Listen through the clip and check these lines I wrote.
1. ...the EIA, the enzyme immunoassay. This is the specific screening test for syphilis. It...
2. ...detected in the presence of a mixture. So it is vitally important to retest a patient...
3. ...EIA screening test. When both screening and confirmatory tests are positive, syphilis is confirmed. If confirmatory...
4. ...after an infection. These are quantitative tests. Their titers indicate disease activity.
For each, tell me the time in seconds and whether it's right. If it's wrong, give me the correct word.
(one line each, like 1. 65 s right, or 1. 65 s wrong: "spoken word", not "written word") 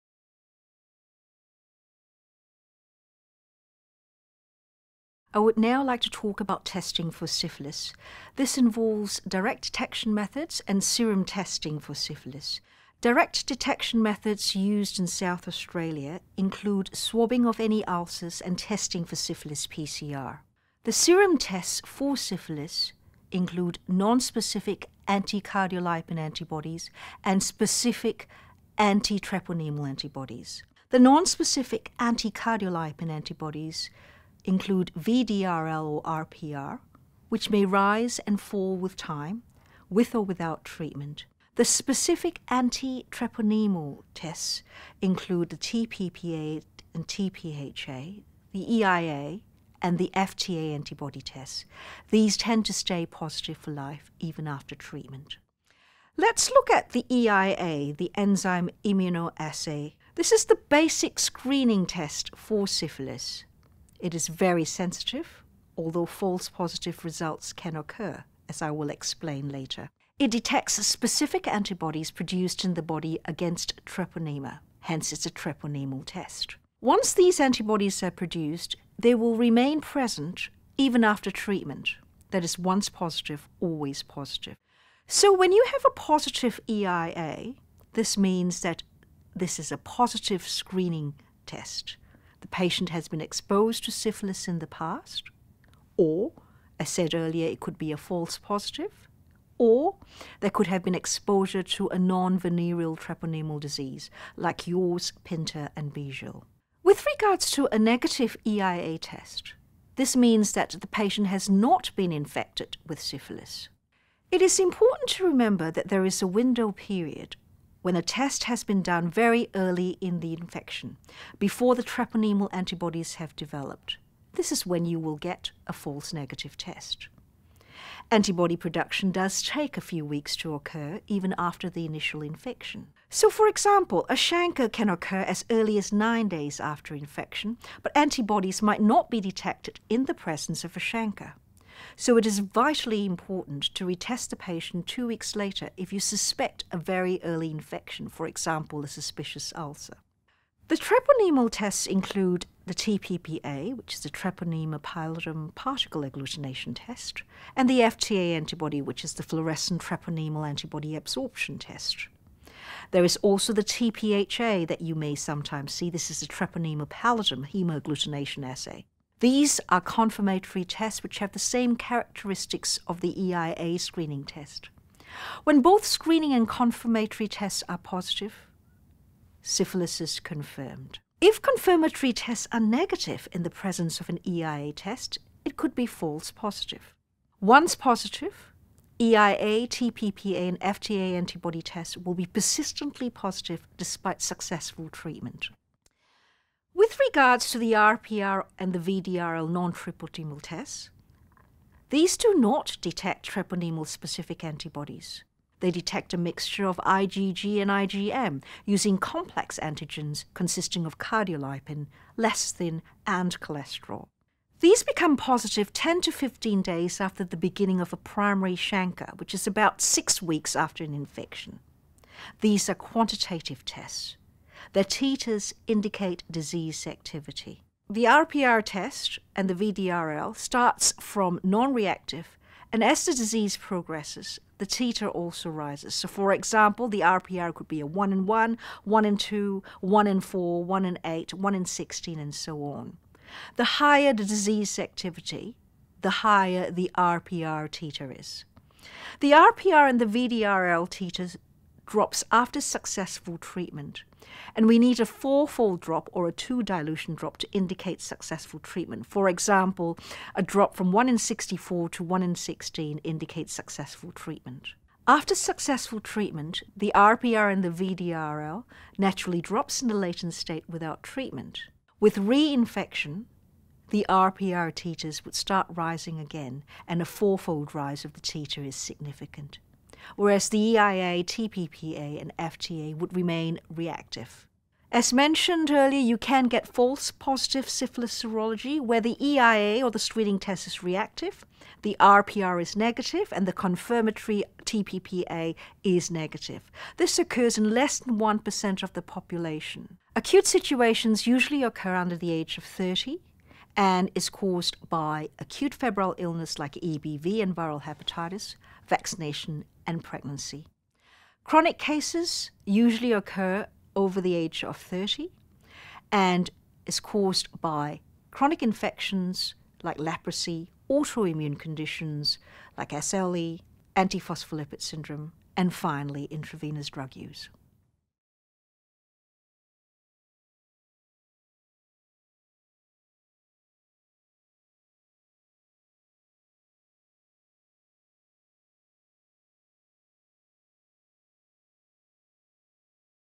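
1. 56 s wrong: "basic", not "specific"
2. 139 s wrong: "chancre", not "mixture"
3. 173 s right
4. 220 s right.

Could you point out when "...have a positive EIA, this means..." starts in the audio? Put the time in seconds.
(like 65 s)
85 s.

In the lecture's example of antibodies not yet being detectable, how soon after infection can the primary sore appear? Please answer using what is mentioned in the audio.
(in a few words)
9 days.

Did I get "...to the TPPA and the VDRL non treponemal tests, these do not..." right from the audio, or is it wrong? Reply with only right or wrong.
wrong.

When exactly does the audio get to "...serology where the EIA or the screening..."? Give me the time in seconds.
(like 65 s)
288 s.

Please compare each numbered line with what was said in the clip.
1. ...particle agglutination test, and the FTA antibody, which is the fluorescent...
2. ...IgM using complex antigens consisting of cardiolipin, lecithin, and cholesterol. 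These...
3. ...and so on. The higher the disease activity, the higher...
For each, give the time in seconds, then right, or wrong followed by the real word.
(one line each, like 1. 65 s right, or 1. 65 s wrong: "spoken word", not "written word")
1. 155 s right
2. 207 s right
3. 242 s right.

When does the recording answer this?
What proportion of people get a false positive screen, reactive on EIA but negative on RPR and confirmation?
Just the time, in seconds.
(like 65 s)
297 s.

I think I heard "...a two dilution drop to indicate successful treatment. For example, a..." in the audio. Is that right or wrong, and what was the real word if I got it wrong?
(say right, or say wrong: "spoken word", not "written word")
right.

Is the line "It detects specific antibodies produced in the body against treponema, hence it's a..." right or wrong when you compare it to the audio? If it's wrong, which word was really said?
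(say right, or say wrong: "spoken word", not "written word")
right.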